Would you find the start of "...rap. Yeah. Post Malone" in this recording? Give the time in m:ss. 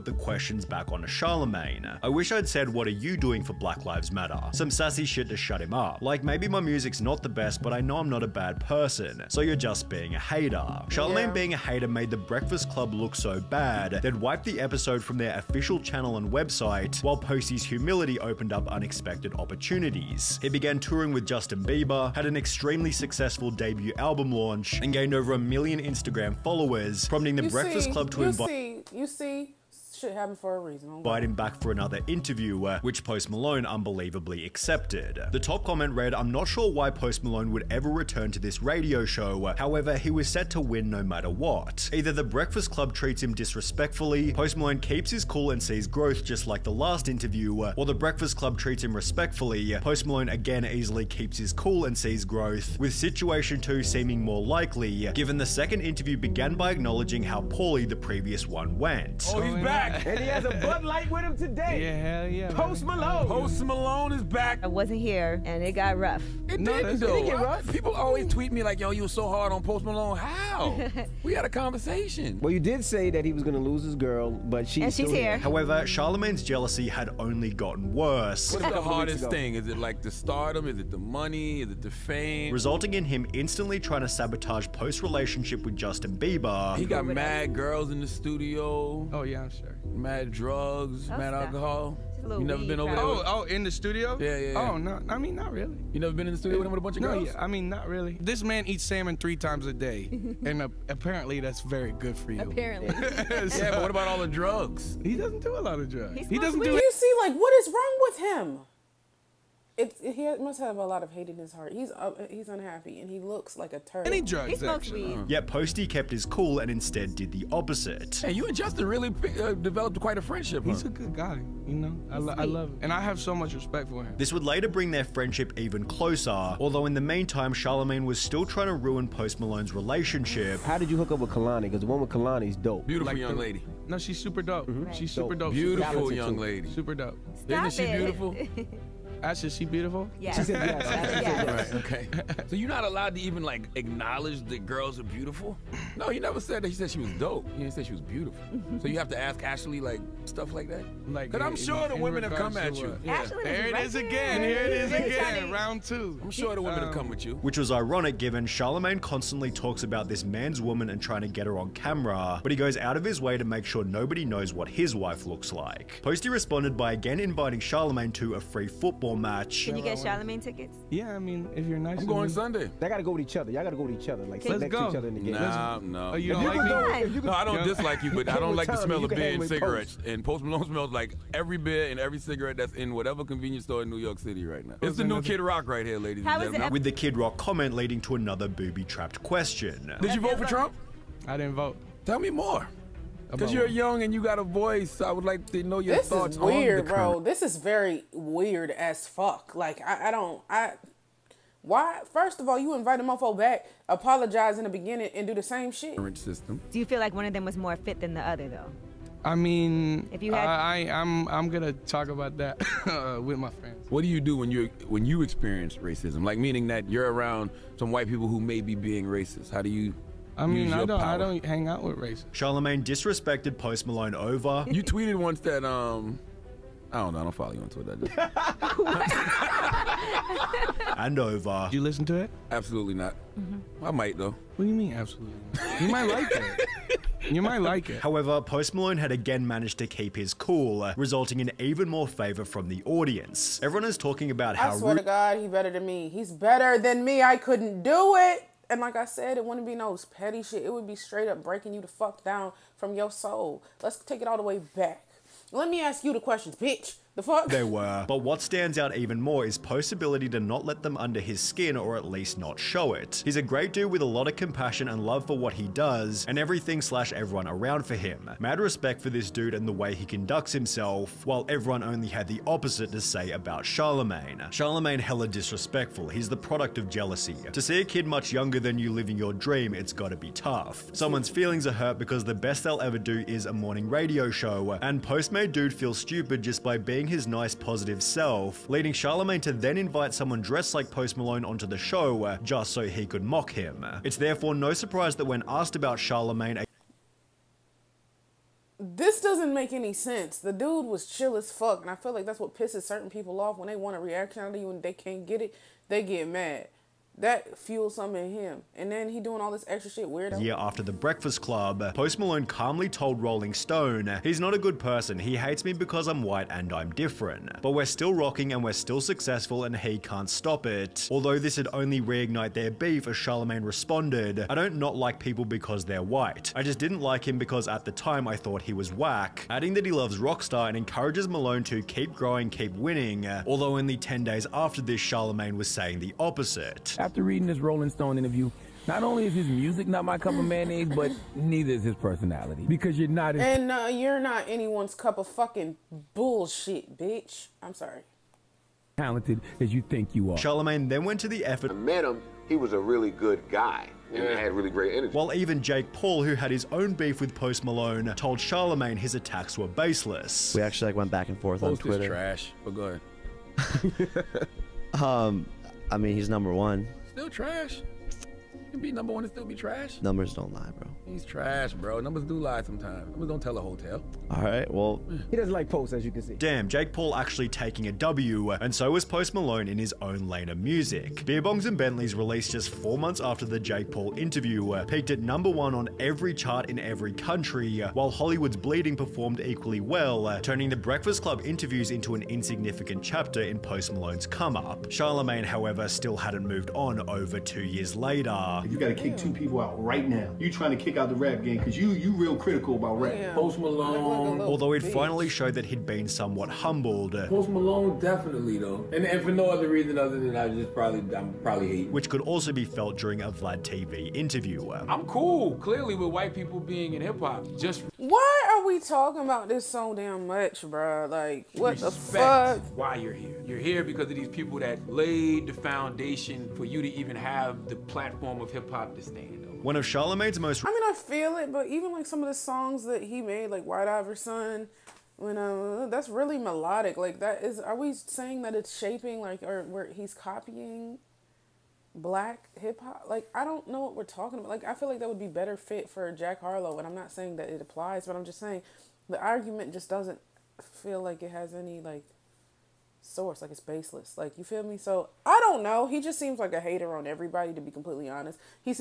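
6:43.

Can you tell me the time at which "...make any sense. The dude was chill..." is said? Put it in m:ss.
4:59.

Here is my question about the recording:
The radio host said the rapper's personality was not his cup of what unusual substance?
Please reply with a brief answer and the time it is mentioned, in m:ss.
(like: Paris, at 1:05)
mayonnaise, at 5:40.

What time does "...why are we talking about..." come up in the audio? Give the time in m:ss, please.
6:57.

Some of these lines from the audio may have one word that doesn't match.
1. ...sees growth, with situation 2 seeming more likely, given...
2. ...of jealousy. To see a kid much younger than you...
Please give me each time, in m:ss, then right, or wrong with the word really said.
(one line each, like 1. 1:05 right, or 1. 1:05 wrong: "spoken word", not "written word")
1. 0:51 right
2. 4:36 right.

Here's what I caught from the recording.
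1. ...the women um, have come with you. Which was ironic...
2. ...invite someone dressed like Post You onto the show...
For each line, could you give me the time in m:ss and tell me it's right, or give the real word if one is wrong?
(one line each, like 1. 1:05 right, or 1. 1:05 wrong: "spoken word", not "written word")
1. 2:36 right
2. 4:49 wrong: "Malone", not "You".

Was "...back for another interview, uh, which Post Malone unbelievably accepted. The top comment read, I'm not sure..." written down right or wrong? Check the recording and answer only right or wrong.
right.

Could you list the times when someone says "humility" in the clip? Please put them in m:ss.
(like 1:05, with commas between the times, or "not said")
0:17.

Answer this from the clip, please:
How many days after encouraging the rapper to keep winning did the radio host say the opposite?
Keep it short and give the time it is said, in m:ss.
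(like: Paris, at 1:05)
10 days, at 5:33.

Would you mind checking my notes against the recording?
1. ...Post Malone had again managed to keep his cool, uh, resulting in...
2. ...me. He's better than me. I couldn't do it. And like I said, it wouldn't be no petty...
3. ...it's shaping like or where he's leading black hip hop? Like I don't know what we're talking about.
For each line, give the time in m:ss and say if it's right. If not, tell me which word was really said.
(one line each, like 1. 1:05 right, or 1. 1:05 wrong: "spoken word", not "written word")
1. 3:58 right
2. 4:05 right
3. 7:18 wrong: "copying", not "leading".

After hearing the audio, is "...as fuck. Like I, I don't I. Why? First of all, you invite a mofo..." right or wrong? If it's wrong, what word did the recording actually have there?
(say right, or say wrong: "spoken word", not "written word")
right.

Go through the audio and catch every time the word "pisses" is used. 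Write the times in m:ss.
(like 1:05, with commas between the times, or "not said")
5:02.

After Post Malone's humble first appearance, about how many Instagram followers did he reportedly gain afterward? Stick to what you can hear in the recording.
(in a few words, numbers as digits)
over a million.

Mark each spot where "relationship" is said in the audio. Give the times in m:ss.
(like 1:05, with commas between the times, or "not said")
1:25, 2:09.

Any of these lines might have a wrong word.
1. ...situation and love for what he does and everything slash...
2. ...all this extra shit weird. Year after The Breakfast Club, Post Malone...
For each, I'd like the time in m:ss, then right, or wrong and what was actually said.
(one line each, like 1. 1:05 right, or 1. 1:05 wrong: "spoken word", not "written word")
1. 4:24 wrong: "compassion", not "situation"
2. 5:09 right.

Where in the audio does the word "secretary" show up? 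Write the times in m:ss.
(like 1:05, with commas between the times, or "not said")
not said.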